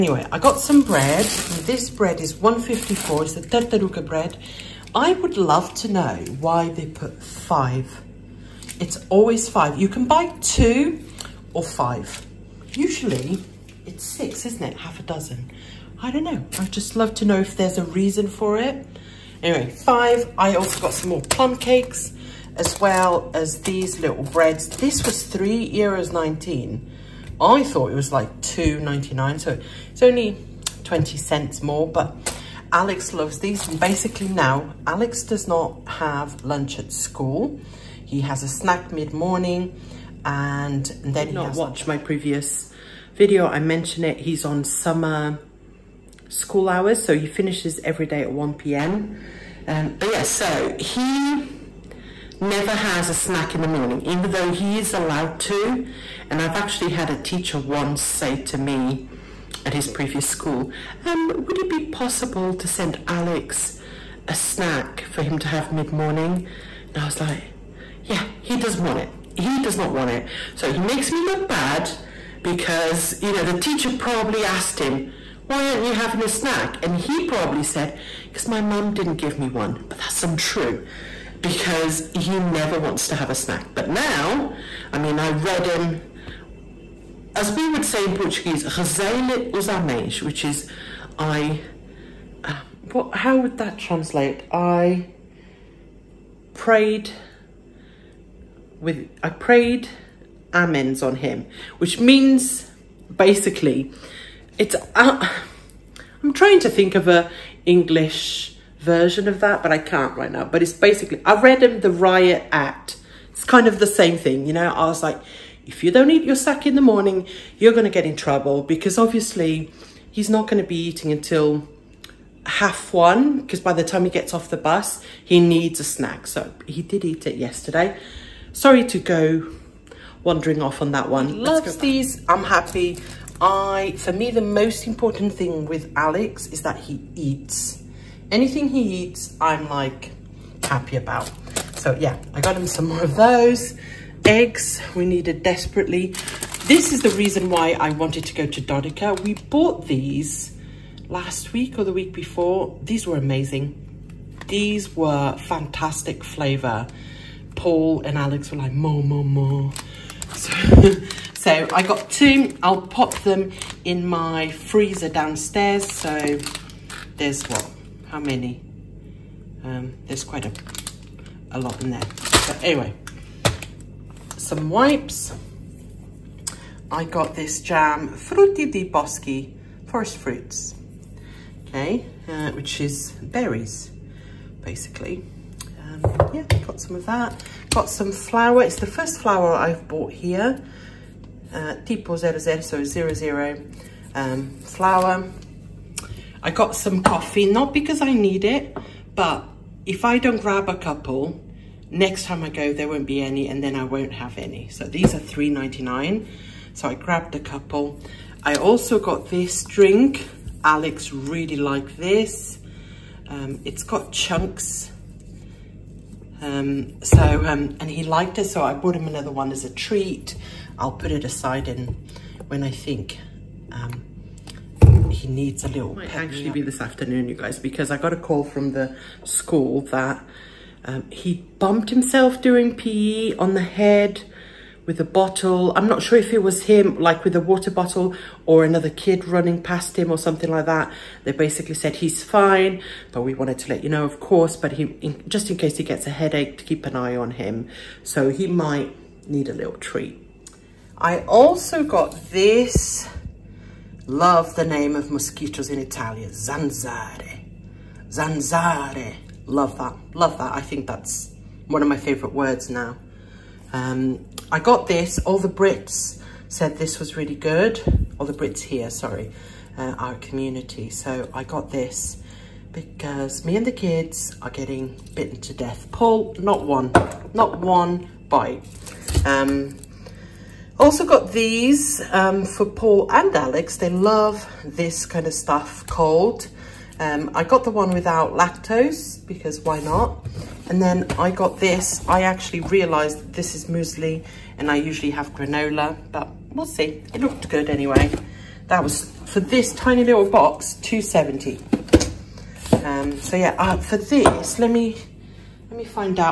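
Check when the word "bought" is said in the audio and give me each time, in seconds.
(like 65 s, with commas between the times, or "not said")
149 s, 189 s, 218 s.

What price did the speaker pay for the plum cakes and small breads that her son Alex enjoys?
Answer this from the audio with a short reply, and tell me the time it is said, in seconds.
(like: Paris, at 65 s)
€3.19, at 25 s.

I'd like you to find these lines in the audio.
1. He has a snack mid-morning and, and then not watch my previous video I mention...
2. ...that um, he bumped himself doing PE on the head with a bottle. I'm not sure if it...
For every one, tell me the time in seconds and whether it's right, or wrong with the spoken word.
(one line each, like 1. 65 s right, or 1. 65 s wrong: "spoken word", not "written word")
1. 38 s right
2. 229 s right.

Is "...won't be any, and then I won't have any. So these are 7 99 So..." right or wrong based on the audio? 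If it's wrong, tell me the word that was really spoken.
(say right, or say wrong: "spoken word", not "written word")
wrong: "3", not "7".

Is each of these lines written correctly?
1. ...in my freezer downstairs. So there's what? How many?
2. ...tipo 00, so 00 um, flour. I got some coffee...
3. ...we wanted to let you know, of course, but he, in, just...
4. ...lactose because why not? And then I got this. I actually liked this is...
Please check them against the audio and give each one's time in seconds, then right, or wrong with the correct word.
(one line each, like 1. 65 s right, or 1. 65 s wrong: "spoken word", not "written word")
1. 163 s right
2. 191 s right
3. 243 s right
4. 288 s wrong: "realized", not "liked".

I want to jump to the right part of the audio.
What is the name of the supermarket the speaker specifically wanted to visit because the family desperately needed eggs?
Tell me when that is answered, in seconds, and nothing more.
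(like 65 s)
148 s.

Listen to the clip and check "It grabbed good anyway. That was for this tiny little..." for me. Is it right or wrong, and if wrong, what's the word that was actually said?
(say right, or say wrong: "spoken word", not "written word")
wrong: "looked", not "grabbed".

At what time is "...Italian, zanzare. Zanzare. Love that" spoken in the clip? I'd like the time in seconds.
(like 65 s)
255 s.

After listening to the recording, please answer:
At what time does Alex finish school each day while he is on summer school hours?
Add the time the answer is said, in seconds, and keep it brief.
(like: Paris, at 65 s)
1 p.m., at 48 s.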